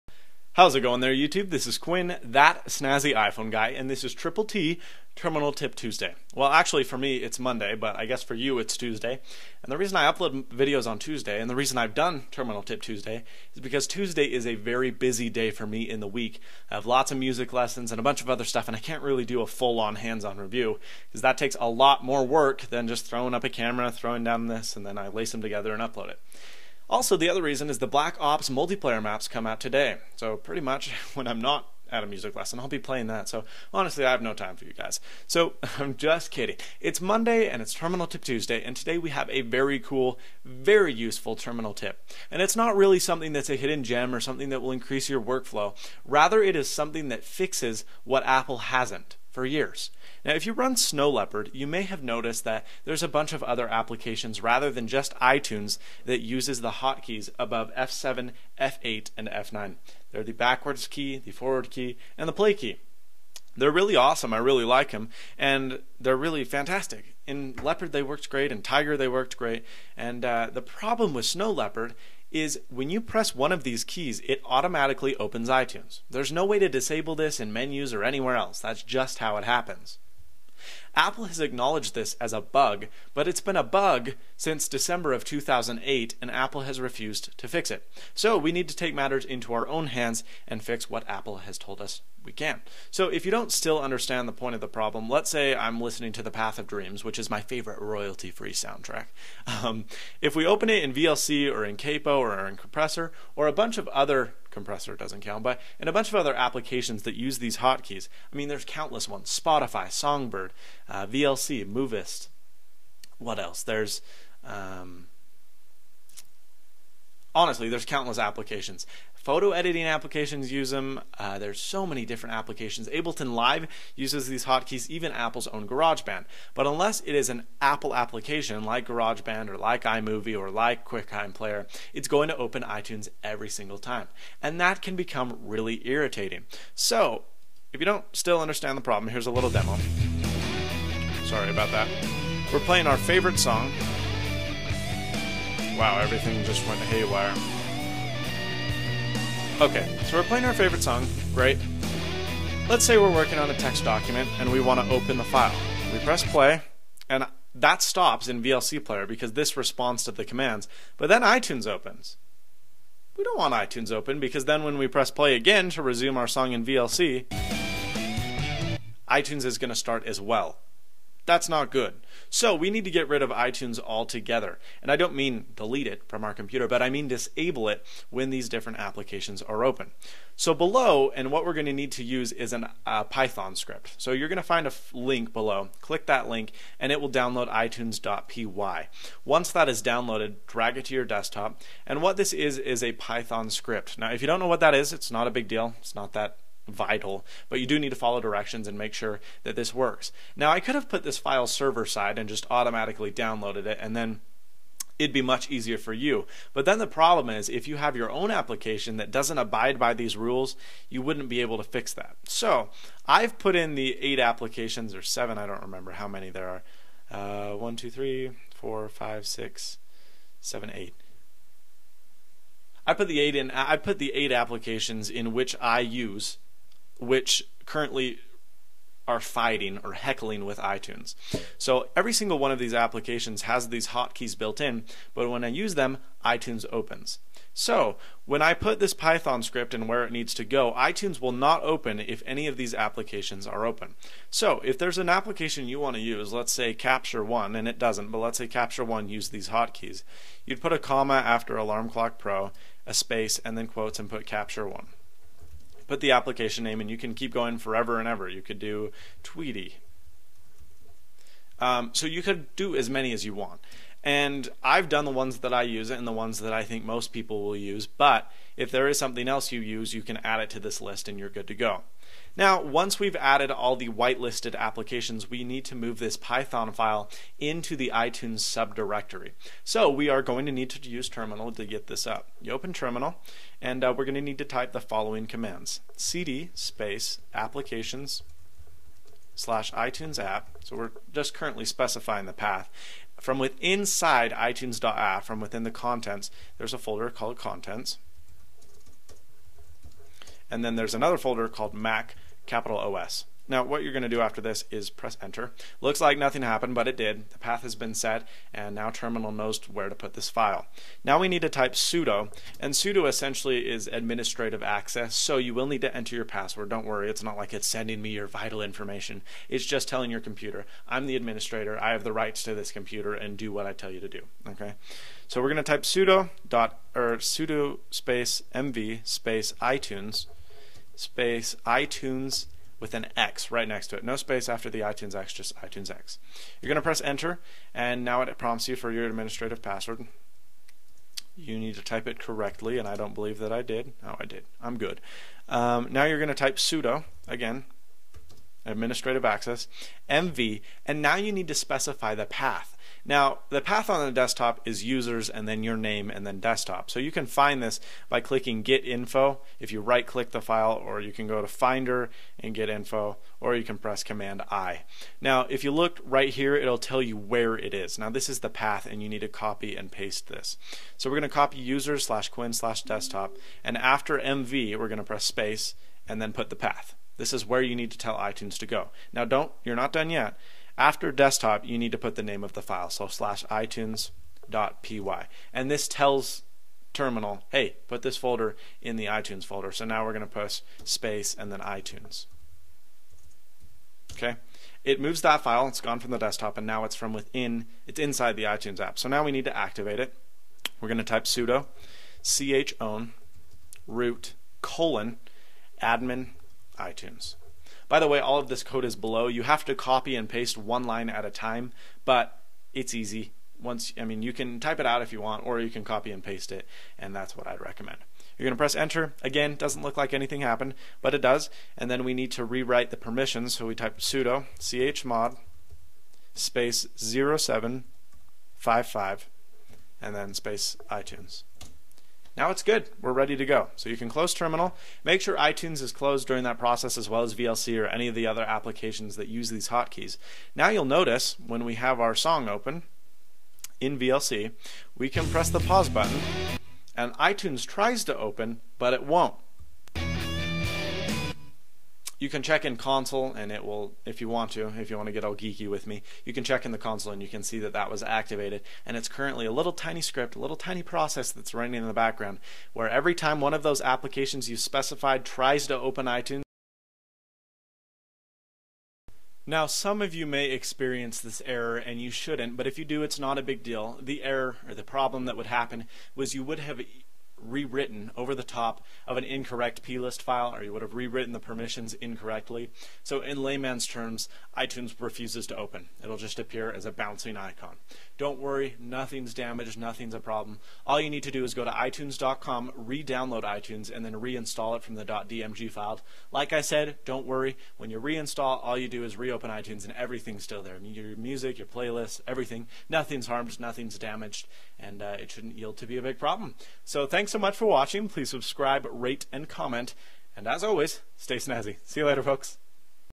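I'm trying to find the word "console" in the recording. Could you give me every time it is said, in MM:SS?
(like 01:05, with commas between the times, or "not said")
07:32, 07:36.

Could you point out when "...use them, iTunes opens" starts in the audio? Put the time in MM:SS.
03:55.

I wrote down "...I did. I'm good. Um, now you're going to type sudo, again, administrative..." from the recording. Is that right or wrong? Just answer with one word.
right.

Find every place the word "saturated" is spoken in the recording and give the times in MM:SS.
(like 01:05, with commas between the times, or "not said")
not said.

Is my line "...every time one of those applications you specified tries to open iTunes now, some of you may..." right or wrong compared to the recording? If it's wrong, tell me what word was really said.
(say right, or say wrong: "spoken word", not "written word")
right.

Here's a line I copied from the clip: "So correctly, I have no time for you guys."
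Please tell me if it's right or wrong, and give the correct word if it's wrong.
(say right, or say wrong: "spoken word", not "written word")
wrong: "honestly", not "correctly".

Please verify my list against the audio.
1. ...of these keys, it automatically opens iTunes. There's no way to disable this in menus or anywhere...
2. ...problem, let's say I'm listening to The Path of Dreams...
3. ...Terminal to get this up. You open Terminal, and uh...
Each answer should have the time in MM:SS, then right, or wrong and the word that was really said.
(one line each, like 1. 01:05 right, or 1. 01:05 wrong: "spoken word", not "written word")
1. 01:13 right
2. 01:34 right
3. 04:41 right.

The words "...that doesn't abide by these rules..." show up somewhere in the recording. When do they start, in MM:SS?
03:28.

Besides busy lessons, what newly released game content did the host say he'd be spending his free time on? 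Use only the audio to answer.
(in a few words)
Black Ops multiplayer maps.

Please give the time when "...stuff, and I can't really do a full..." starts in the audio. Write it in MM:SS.
00:18.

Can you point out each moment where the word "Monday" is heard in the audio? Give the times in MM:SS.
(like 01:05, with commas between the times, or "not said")
00:07, 00:37.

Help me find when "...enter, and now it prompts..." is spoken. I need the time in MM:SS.
05:37.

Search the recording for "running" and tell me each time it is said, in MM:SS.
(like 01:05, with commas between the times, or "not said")
07:41.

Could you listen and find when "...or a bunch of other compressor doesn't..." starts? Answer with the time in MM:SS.
01:43.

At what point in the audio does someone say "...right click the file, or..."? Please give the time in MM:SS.
05:59.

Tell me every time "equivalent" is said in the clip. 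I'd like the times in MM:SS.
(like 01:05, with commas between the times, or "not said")
not said.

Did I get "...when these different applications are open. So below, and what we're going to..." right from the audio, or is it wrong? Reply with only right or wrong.
right.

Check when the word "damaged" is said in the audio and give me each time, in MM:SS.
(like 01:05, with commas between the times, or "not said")
08:09, 08:23.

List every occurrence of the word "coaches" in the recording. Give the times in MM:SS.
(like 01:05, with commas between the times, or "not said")
not said.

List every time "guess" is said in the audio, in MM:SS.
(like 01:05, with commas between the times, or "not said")
00:08.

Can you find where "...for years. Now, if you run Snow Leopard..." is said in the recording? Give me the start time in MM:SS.
00:49.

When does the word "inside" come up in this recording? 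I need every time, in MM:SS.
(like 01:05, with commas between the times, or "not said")
04:53, 06:37.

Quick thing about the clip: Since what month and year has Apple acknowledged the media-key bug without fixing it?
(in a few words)
December 2008.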